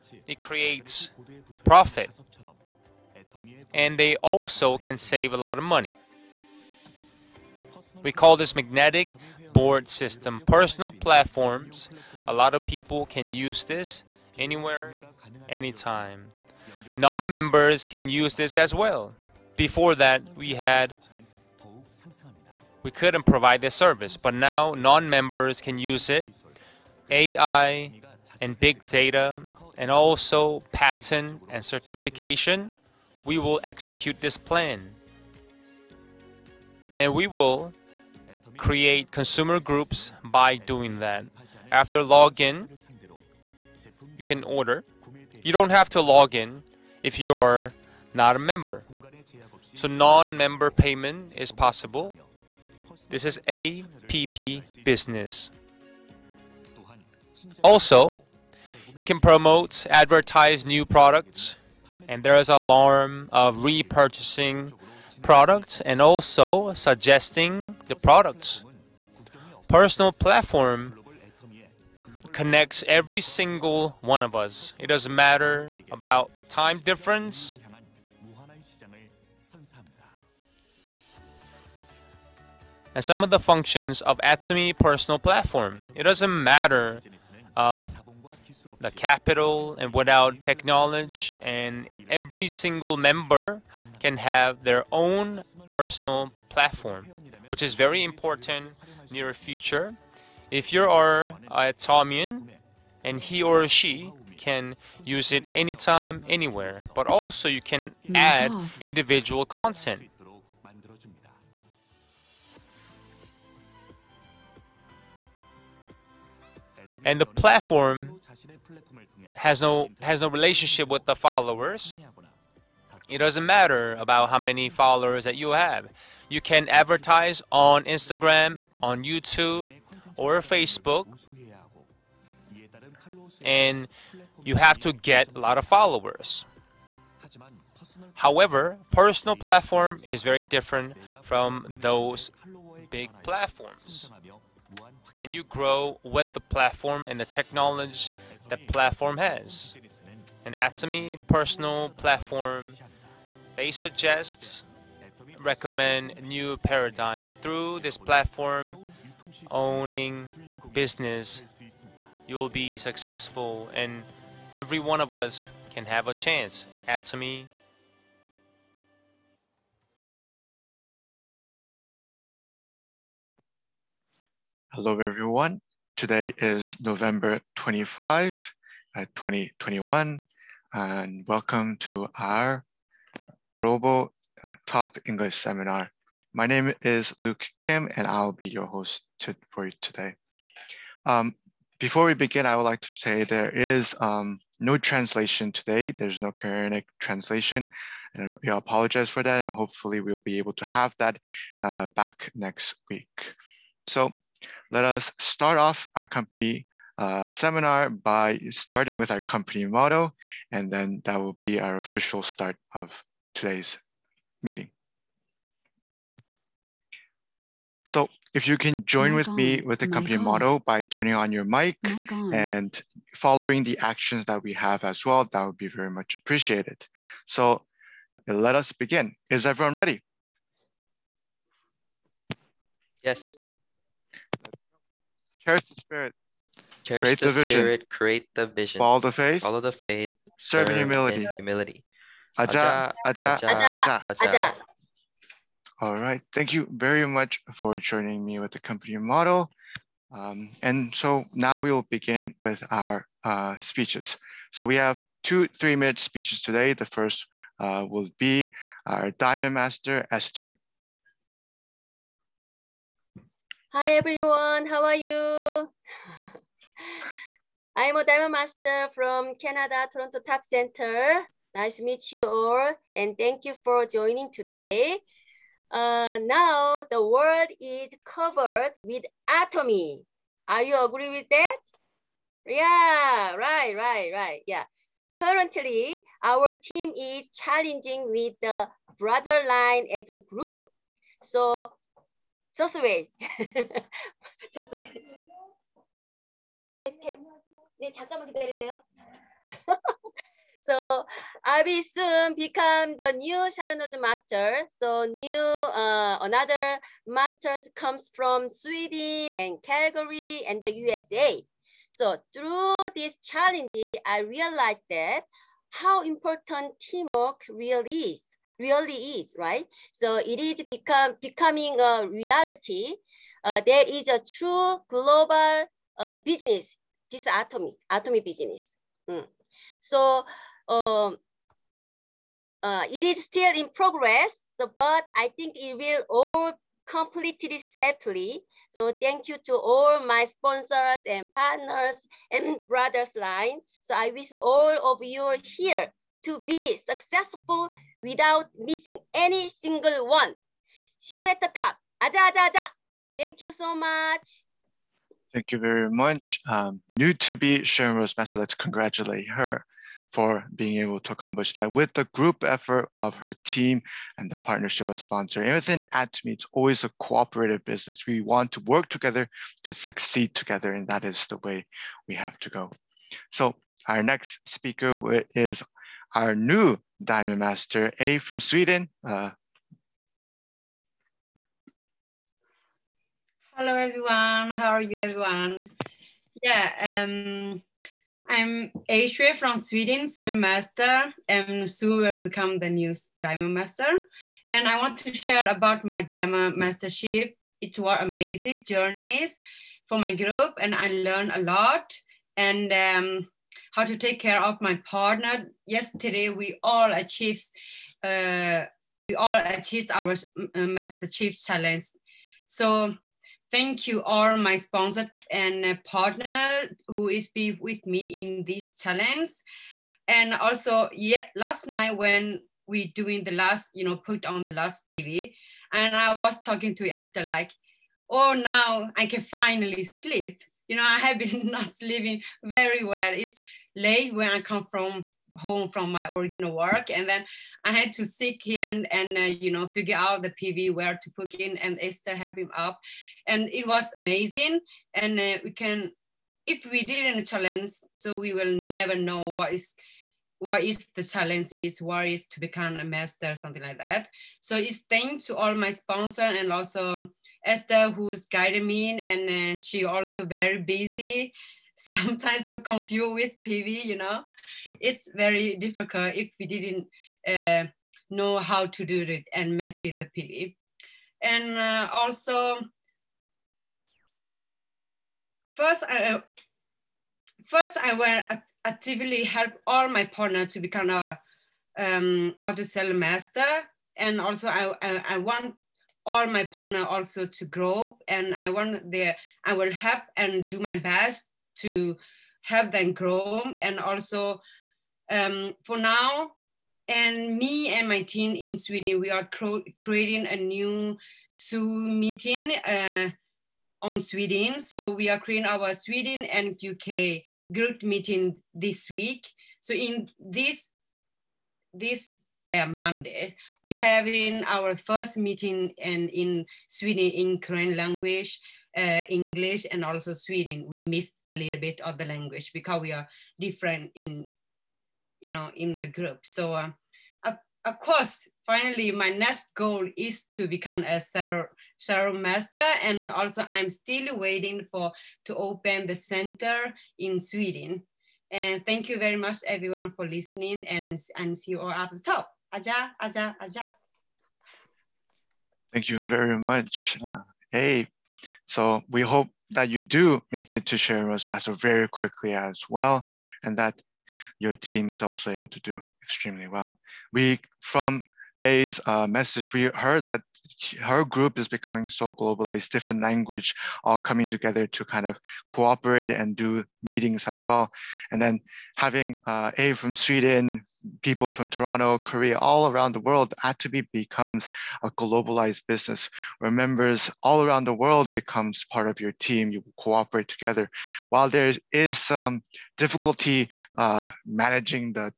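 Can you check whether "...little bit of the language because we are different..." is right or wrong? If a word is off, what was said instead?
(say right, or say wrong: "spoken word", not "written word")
right.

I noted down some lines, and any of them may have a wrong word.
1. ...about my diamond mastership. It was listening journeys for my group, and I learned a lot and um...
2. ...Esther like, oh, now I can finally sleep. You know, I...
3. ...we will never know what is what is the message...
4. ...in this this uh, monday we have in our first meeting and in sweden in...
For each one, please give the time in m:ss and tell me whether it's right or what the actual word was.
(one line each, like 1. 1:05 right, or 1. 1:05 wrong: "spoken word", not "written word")
1. 6:35 wrong: "amazing", not "listening"
2. 7:06 right
3. 7:28 wrong: "challenge", not "message"
4. 8:29 right.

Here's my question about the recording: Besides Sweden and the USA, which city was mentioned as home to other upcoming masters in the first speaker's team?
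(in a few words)
Calgary.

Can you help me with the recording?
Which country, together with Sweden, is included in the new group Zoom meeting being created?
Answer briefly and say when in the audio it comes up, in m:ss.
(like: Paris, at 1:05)
UK, at 8:26.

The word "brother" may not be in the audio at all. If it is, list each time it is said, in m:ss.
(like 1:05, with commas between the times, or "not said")
4:48, 5:42.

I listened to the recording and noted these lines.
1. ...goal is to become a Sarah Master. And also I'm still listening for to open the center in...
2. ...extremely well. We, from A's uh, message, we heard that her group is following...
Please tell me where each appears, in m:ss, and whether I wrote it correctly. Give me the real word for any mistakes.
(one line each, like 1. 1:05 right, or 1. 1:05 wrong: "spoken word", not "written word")
1. 8:49 wrong: "waiting", not "listening"
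2. 9:16 wrong: "becoming", not "following".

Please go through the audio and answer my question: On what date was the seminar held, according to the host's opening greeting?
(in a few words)
November 25, 2021.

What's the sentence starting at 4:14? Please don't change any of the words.
So we have two three-minute speeches today.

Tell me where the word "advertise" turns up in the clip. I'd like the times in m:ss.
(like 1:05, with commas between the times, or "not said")
0:59, 2:06.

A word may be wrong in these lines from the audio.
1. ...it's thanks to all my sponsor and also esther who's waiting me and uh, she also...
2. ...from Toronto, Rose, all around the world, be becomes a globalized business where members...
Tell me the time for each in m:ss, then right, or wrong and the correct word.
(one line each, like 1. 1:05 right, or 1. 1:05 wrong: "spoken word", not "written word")
1. 7:34 wrong: "guiding", not "waiting"
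2. 9:31 wrong: "Korea", not "Rose".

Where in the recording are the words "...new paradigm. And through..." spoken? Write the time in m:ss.
2:36.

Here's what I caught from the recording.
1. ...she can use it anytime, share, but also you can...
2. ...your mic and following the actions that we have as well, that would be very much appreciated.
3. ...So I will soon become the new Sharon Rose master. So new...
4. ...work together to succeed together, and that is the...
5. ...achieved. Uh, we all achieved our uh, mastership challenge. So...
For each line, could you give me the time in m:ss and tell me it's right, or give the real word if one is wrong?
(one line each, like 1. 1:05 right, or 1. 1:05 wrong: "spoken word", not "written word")
1. 1:43 wrong: "anywhere", not "share"
2. 3:41 right
3. 5:00 right
4. 6:08 right
5. 6:46 right.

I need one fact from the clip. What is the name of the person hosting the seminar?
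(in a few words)
Luke Kim.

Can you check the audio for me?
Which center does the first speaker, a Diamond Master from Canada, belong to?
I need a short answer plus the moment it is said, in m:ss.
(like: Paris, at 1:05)
Toronto Top Center, at 4:29.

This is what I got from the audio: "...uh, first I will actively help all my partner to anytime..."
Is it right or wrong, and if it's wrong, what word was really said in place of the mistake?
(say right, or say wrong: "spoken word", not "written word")
wrong: "become", not "anytime".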